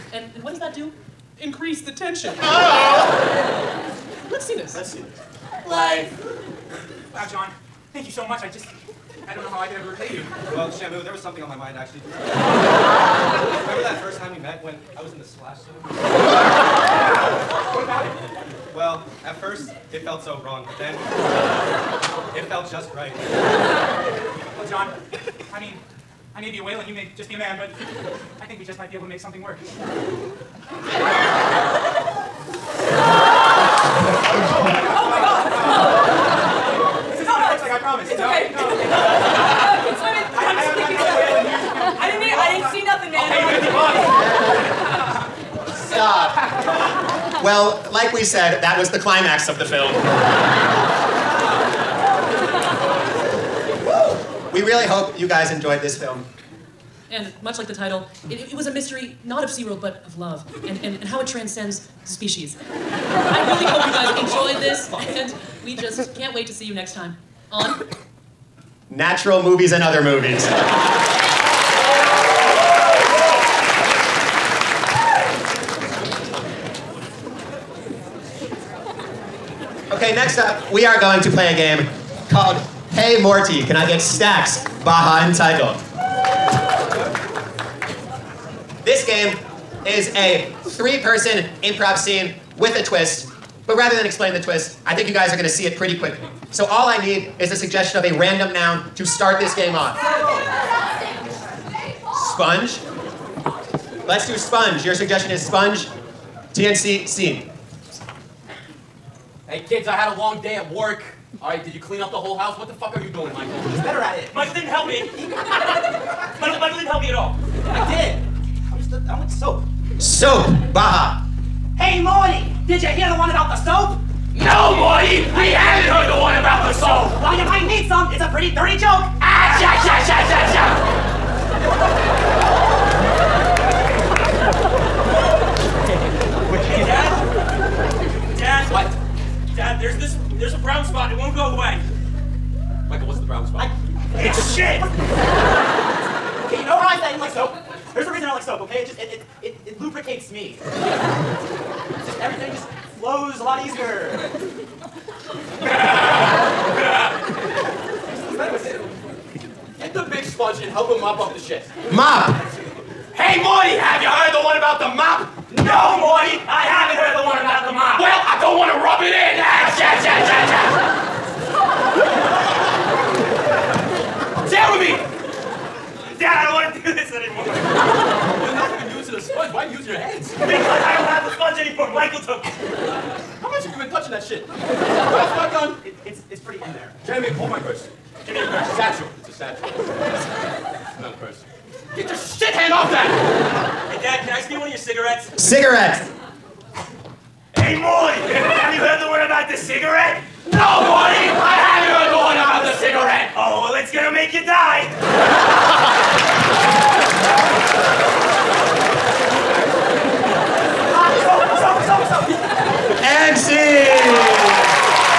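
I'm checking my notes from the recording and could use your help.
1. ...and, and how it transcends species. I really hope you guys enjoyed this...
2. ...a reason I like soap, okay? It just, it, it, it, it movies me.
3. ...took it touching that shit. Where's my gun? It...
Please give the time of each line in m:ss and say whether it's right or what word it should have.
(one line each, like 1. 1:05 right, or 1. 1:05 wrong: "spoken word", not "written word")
1. 1:00 right
2. 2:28 wrong: "lubricates", not "movies"
3. 3:02 right.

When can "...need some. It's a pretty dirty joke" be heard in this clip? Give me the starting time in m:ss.
2:07.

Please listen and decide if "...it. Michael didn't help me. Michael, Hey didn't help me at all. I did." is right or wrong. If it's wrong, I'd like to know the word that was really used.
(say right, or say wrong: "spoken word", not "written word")
wrong: "Michael", not "Hey".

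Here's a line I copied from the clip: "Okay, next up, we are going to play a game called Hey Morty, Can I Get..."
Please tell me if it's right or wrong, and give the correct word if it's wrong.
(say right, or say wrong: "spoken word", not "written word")
right.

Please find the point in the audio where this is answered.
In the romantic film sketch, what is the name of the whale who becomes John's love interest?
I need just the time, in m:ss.
0:10.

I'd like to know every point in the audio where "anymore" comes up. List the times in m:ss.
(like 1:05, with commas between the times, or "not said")
2:57, 3:01.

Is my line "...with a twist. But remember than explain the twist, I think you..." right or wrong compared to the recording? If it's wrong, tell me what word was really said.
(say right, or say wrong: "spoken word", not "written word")
wrong: "rather", not "remember".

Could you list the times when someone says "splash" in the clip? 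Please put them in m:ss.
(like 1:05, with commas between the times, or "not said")
0:15.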